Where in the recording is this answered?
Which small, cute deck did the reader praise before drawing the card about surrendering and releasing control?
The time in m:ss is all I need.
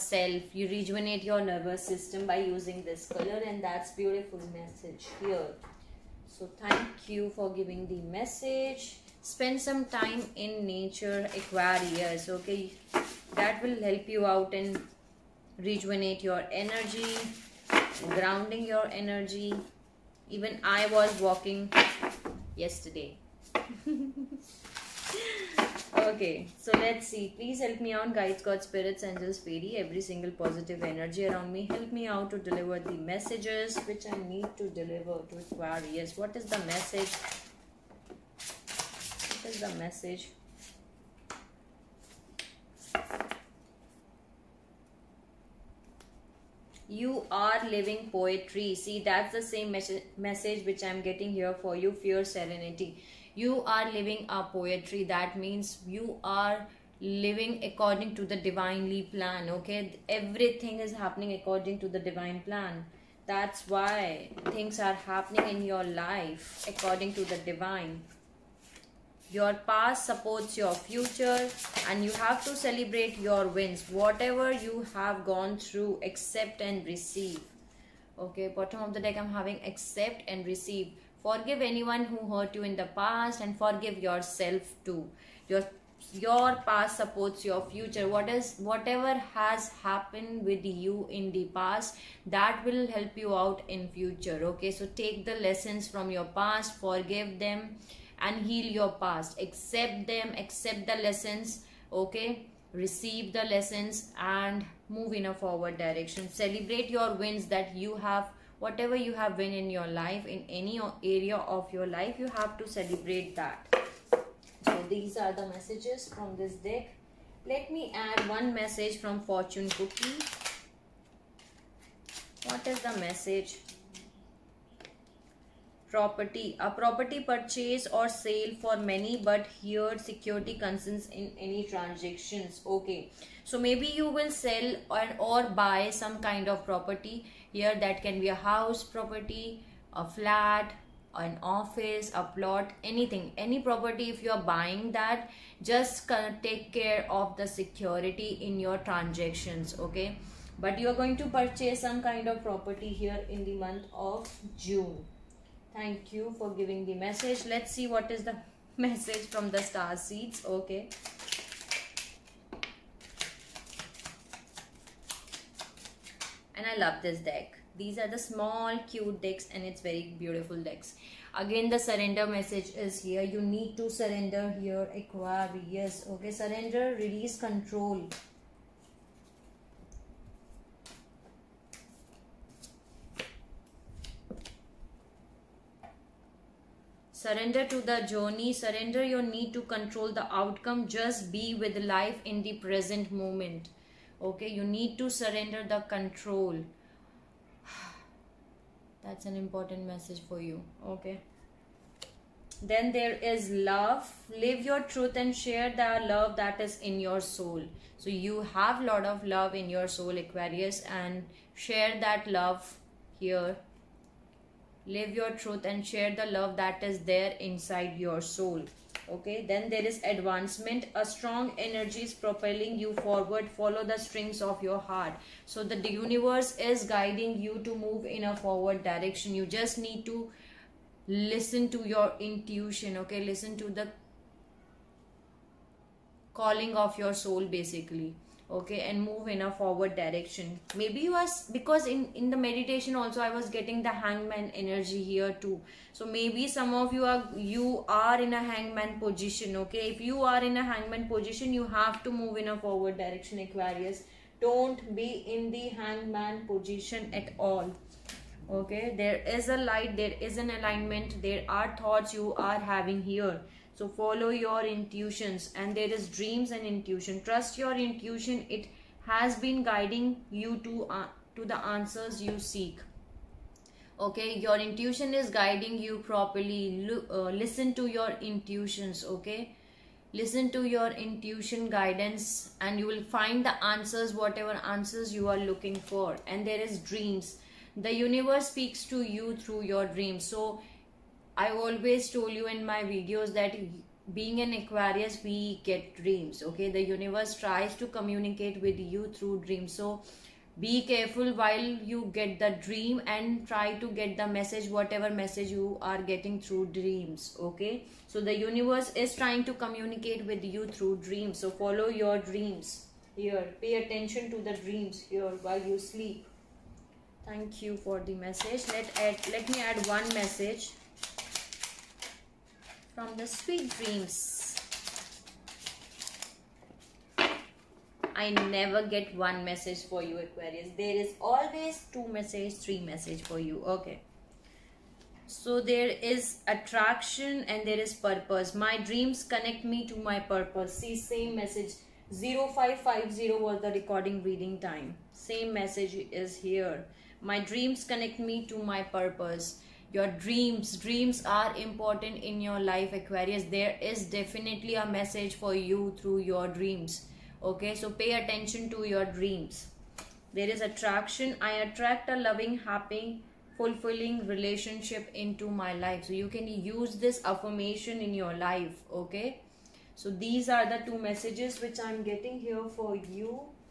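2:39.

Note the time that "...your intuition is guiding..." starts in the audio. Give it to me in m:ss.
4:34.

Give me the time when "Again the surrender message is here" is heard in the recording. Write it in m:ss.
2:51.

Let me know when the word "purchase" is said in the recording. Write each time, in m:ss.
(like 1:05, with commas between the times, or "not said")
2:07, 2:31.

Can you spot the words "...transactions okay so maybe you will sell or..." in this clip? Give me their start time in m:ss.
2:11.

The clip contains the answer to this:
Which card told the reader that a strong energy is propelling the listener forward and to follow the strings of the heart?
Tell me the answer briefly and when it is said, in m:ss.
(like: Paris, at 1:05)
Advancement, at 3:40.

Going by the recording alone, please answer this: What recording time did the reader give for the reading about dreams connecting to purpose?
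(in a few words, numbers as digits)
0550.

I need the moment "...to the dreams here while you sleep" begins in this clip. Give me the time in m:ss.
5:14.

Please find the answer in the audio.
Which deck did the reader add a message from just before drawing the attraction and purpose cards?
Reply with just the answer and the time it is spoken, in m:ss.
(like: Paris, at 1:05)
Sweet dreams, at 5:23.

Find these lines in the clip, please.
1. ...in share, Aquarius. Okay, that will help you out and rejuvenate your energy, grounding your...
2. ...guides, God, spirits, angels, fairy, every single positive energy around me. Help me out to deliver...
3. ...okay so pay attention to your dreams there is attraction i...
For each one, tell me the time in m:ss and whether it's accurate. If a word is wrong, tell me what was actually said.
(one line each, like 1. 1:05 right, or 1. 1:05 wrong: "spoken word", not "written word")
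1. 0:10 wrong: "nature", not "share"
2. 0:28 right
3. 5:57 right.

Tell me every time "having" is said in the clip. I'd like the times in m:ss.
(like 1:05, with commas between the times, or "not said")
1:19, 4:22.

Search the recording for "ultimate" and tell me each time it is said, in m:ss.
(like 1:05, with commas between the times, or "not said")
not said.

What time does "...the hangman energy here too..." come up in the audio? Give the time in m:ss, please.
4:03.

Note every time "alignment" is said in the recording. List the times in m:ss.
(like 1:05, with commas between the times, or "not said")
4:20.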